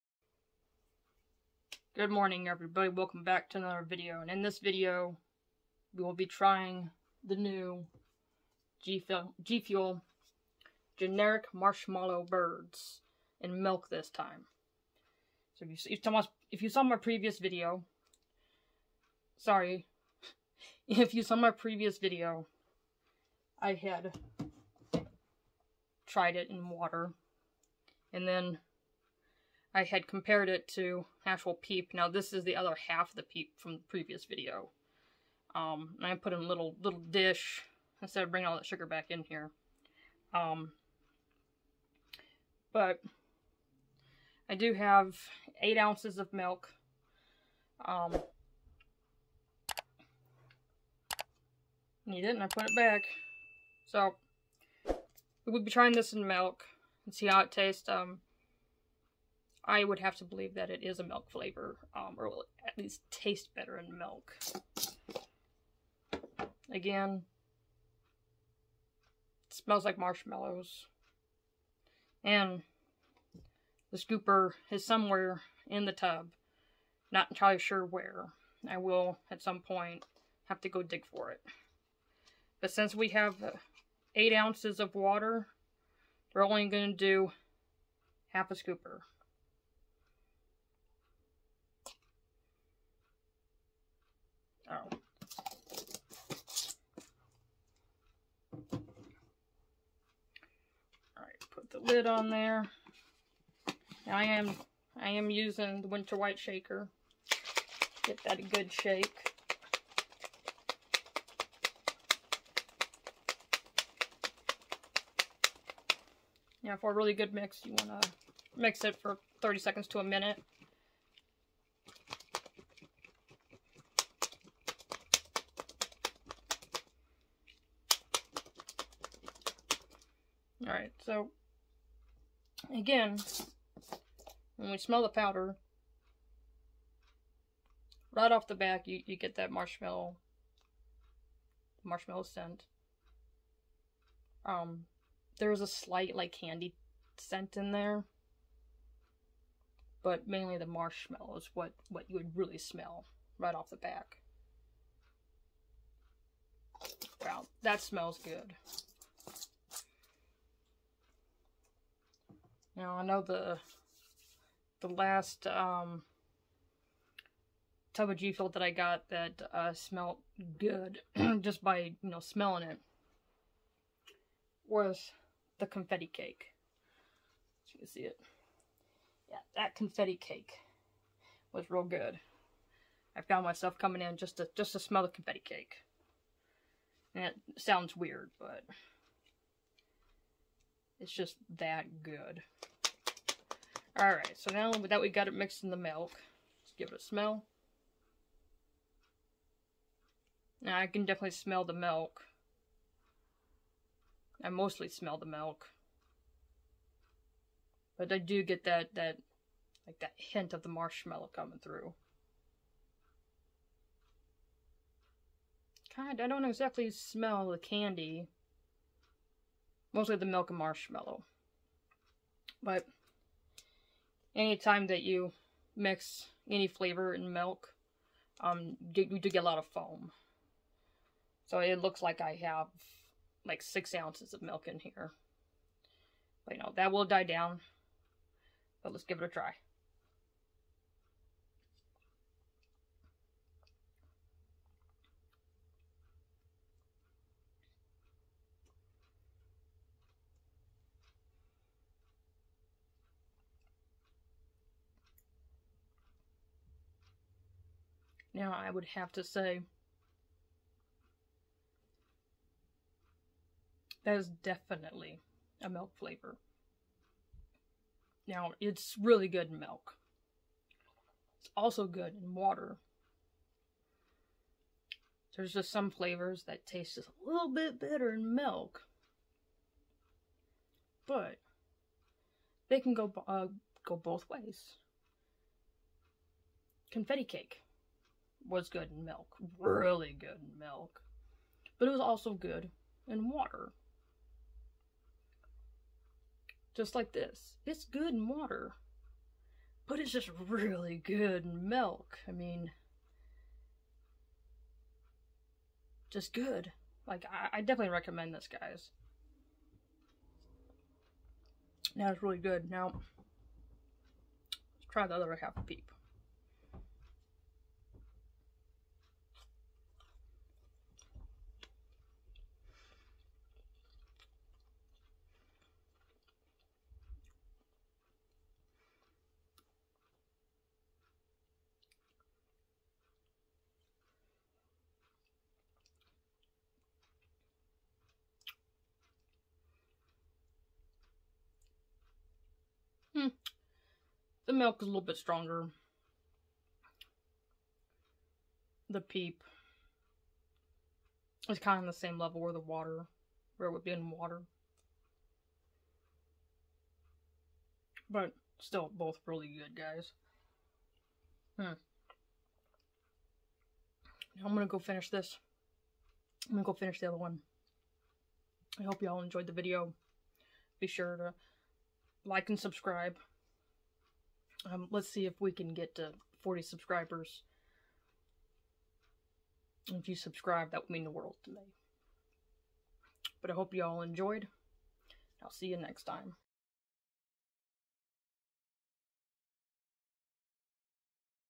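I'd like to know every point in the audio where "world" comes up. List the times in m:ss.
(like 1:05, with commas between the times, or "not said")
6:21.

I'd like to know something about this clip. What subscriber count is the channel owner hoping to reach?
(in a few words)
40.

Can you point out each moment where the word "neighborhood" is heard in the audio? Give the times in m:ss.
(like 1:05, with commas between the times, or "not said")
not said.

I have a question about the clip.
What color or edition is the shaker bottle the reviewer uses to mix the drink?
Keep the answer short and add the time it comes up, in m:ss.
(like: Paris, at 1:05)
winter white, at 1:45.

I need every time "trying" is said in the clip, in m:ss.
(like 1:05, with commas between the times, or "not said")
0:06, 0:55.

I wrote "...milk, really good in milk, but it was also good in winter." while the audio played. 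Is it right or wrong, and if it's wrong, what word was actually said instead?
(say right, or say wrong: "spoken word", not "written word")
wrong: "water", not "winter".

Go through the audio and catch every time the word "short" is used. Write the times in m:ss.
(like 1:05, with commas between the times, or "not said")
not said.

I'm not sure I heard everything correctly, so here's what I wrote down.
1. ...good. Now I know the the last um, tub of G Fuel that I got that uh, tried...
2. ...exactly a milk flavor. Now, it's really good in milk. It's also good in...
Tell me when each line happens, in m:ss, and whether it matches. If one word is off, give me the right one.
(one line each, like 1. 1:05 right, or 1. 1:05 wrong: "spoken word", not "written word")
1. 2:38 wrong: "smelled", not "tried"
2. 4:24 wrong: "definitely", not "exactly".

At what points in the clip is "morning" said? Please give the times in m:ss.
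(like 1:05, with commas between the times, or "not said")
0:02.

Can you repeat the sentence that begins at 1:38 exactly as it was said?
All right, put the lid on there.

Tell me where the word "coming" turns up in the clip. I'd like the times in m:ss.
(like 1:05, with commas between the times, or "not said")
3:03, 3:31.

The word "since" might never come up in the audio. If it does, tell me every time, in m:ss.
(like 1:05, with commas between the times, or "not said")
1:22.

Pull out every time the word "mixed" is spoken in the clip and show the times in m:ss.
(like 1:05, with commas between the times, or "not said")
3:15.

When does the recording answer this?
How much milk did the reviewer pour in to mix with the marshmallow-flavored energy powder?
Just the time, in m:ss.
0:45.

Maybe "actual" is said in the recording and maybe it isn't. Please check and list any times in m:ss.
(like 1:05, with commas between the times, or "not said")
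0:31.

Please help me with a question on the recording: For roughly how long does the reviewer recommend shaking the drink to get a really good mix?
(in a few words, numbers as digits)
30 seconds to a minute.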